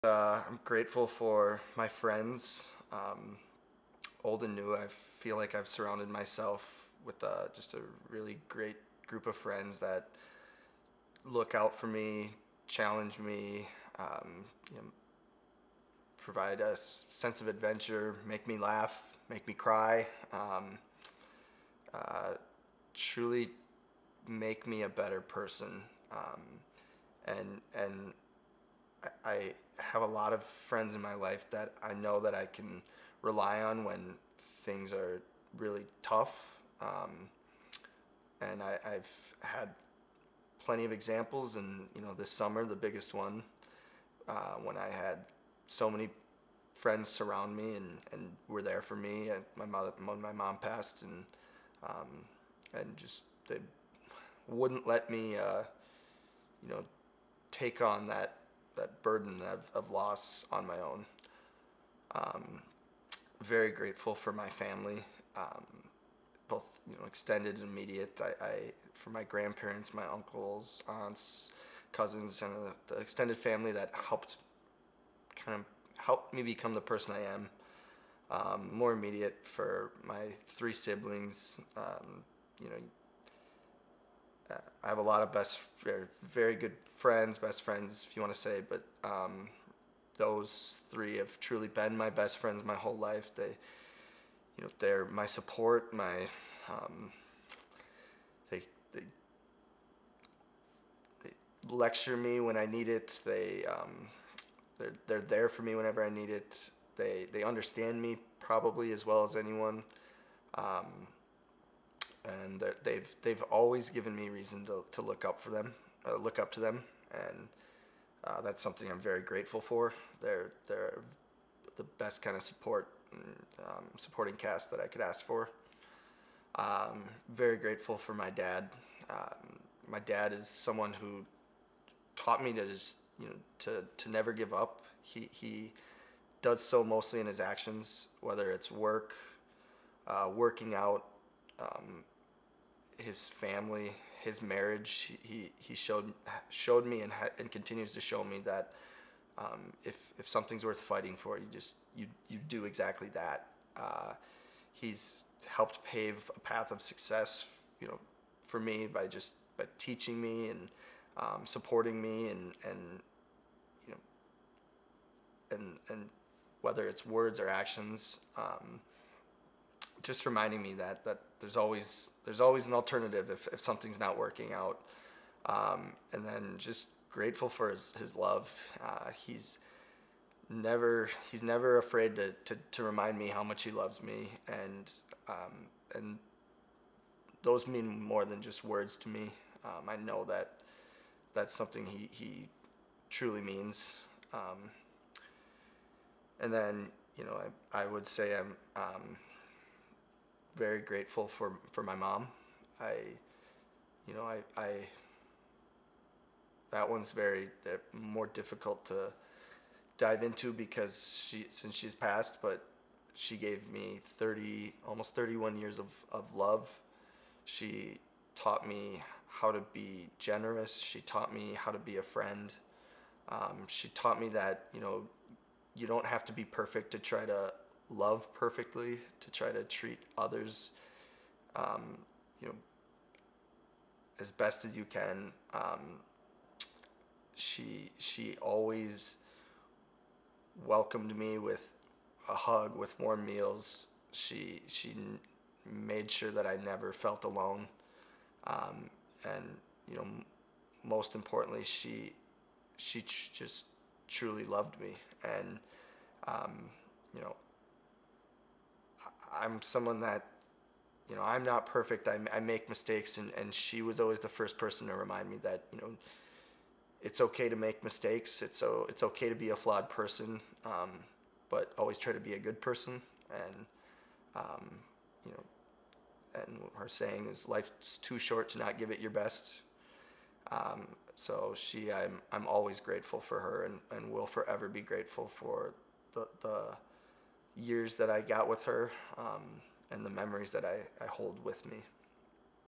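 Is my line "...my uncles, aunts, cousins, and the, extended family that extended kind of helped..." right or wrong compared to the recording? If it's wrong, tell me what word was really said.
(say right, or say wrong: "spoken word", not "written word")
wrong: "helped", not "extended".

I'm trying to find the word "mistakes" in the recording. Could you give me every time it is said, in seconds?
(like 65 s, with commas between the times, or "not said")
262 s, 267 s.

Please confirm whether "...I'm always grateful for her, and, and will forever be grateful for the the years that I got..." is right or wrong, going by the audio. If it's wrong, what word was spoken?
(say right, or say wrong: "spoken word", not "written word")
right.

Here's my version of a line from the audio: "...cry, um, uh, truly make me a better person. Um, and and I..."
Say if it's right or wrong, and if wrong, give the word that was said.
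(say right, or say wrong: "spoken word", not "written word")
right.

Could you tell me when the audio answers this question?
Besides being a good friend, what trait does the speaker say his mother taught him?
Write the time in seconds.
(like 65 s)
220 s.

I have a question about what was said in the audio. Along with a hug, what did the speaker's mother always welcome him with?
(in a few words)
Warm meals.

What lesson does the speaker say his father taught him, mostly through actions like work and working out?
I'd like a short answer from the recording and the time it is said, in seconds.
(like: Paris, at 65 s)
Never give up, at 134 s.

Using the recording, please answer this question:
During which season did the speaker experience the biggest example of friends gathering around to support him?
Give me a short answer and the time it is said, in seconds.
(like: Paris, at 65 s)
Summer, at 42 s.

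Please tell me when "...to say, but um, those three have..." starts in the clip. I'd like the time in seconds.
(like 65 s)
88 s.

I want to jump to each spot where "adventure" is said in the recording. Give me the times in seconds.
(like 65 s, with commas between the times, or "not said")
17 s.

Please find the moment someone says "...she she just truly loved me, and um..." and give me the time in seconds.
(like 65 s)
251 s.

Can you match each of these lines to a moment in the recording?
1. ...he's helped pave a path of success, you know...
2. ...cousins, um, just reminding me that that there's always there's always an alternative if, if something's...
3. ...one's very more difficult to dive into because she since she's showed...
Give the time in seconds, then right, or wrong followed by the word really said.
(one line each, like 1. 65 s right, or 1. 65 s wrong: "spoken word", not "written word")
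1. 154 s right
2. 167 s wrong: "actions", not "cousins"
3. 206 s wrong: "passed", not "showed".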